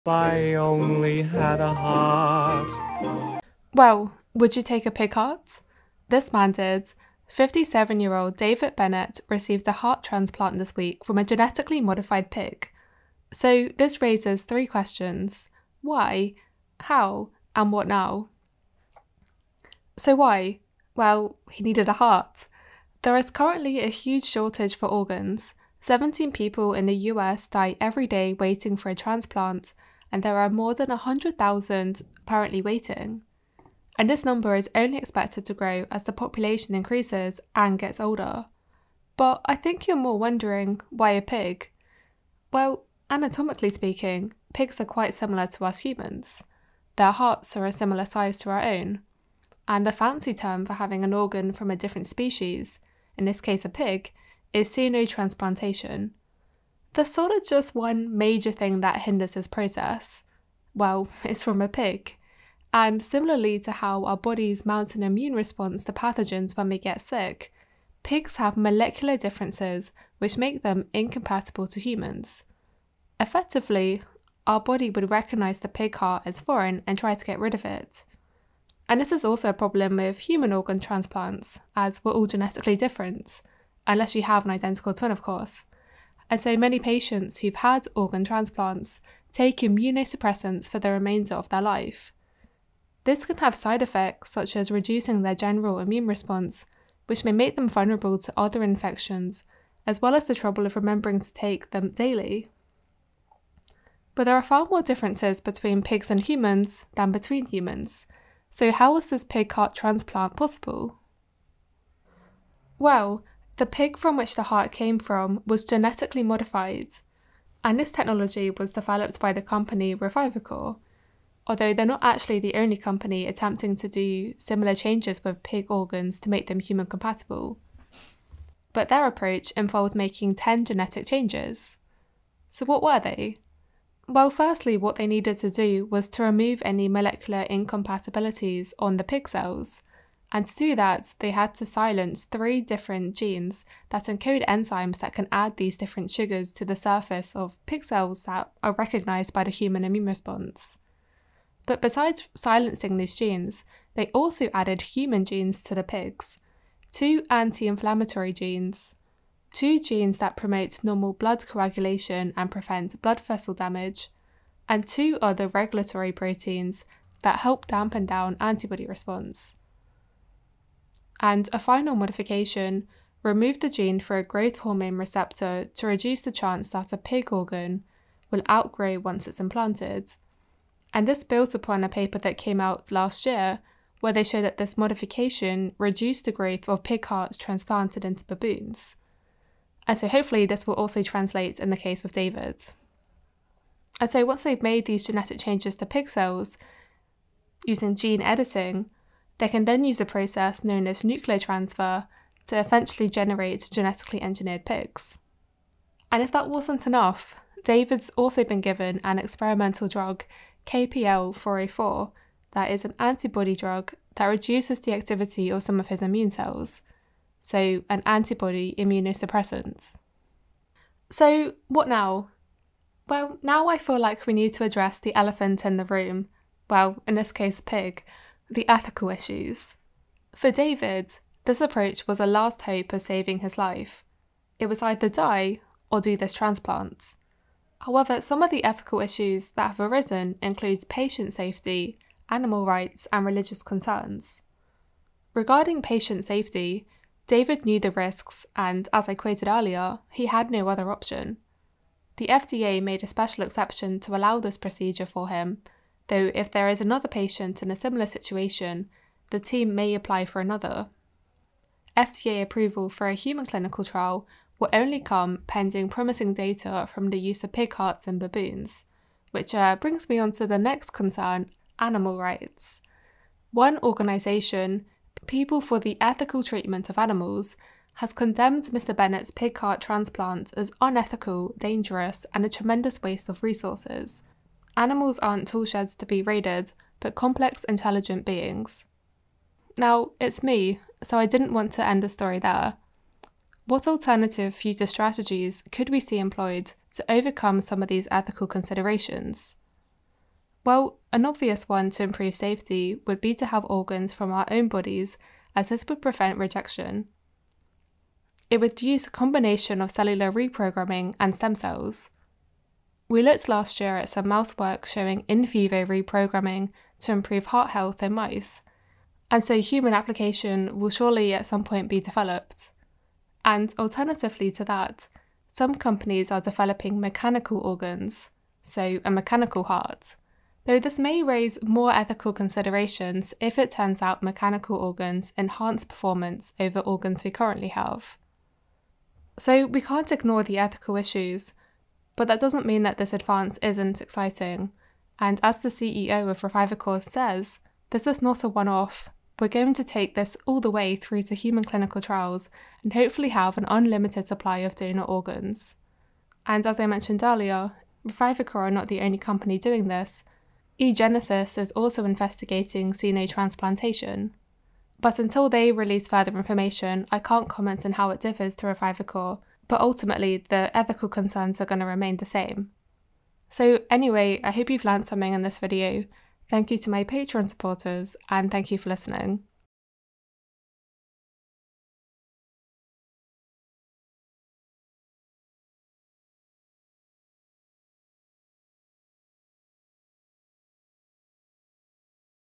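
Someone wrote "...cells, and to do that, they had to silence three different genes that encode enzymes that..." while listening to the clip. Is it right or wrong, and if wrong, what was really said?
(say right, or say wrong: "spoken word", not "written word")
right.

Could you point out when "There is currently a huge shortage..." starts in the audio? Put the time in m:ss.
0:23.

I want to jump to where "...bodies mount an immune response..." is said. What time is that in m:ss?
1:04.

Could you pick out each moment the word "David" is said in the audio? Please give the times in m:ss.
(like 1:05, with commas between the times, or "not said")
0:08, 3:12, 3:27, 3:50, 4:07.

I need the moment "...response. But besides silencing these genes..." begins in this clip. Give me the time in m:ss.
2:30.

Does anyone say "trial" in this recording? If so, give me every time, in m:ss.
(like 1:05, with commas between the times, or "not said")
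4:23, 5:52.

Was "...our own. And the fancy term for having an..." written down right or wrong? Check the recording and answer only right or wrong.
right.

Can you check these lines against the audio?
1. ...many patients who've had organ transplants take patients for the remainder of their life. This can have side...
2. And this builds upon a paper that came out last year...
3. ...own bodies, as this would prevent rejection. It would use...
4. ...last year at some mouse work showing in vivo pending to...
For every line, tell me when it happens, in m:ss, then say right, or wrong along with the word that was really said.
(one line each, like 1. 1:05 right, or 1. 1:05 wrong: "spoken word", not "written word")
1. 1:26 wrong: "immunosuppressants", not "patients"
2. 3:00 right
3. 5:04 right
4. 5:13 wrong: "reprogramming", not "pending".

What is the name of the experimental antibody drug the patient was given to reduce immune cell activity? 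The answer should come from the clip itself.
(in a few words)
KPL 404.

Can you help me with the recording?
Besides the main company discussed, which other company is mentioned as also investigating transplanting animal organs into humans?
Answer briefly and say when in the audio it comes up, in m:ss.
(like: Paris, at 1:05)
eGenesis, at 6:00.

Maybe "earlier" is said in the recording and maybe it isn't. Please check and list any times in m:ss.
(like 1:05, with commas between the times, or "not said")
4:09, 5:57.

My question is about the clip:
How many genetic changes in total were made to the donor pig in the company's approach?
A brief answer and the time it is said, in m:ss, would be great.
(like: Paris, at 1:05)
10, at 2:10.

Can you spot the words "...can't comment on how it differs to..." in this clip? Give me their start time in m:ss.
6:07.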